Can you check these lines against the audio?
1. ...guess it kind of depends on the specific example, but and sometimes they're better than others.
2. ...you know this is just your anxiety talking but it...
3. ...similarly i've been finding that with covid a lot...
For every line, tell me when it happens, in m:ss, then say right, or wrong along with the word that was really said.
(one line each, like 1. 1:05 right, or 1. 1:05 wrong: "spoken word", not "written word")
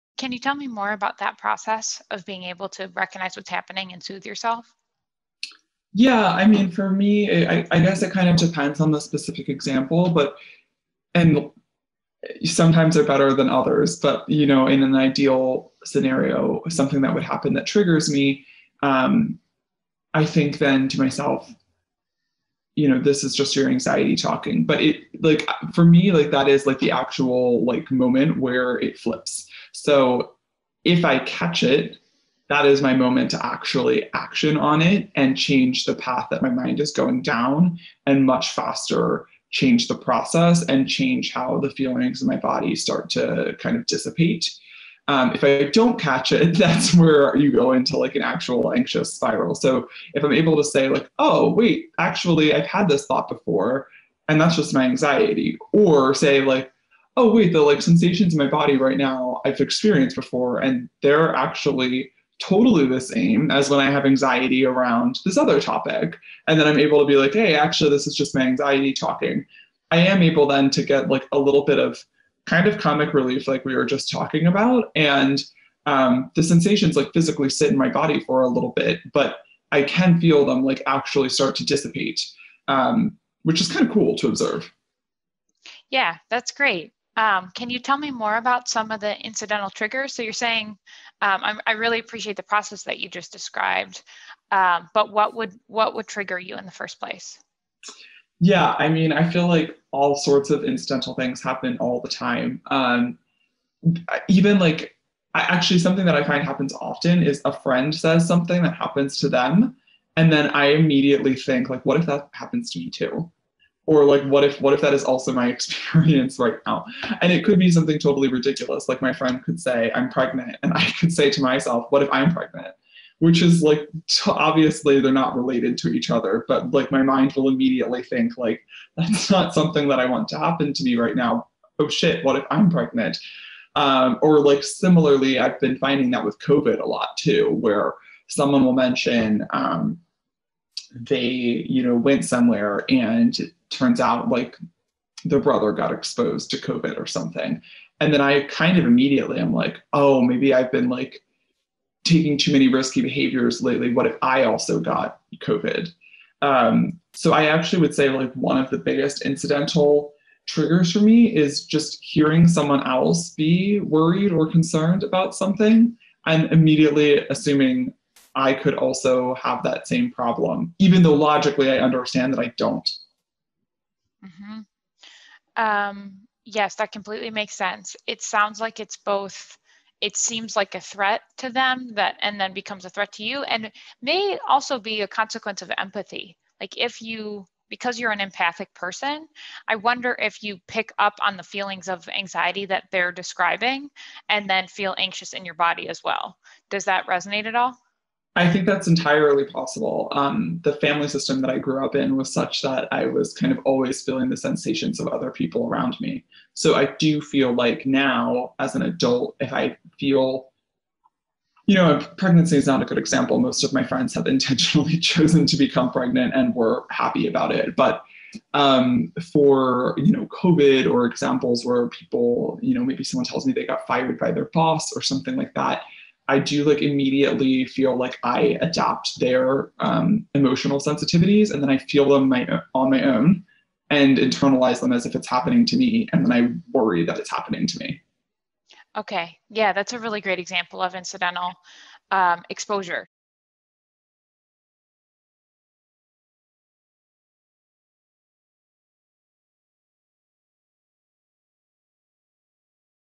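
1. 0:07 right
2. 0:22 right
3. 2:14 right.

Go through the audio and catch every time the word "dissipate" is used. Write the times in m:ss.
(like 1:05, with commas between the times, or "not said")
0:43, 1:21.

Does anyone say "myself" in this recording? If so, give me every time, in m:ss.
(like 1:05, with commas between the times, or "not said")
0:20, 2:01.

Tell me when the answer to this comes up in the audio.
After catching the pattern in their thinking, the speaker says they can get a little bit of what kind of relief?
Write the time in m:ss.
1:12.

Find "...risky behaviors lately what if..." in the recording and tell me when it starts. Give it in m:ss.
2:32.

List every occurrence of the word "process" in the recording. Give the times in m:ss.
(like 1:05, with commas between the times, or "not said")
0:01, 0:39, 1:32.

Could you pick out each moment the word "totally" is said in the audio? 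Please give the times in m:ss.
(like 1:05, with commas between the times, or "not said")
1:02, 1:57.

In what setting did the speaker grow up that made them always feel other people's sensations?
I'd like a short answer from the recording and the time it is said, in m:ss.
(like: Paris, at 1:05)
family system, at 3:20.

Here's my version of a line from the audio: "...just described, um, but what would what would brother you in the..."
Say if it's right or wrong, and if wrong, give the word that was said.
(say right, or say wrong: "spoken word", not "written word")
wrong: "trigger", not "brother".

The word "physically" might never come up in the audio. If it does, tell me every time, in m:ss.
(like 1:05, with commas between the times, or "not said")
1:17.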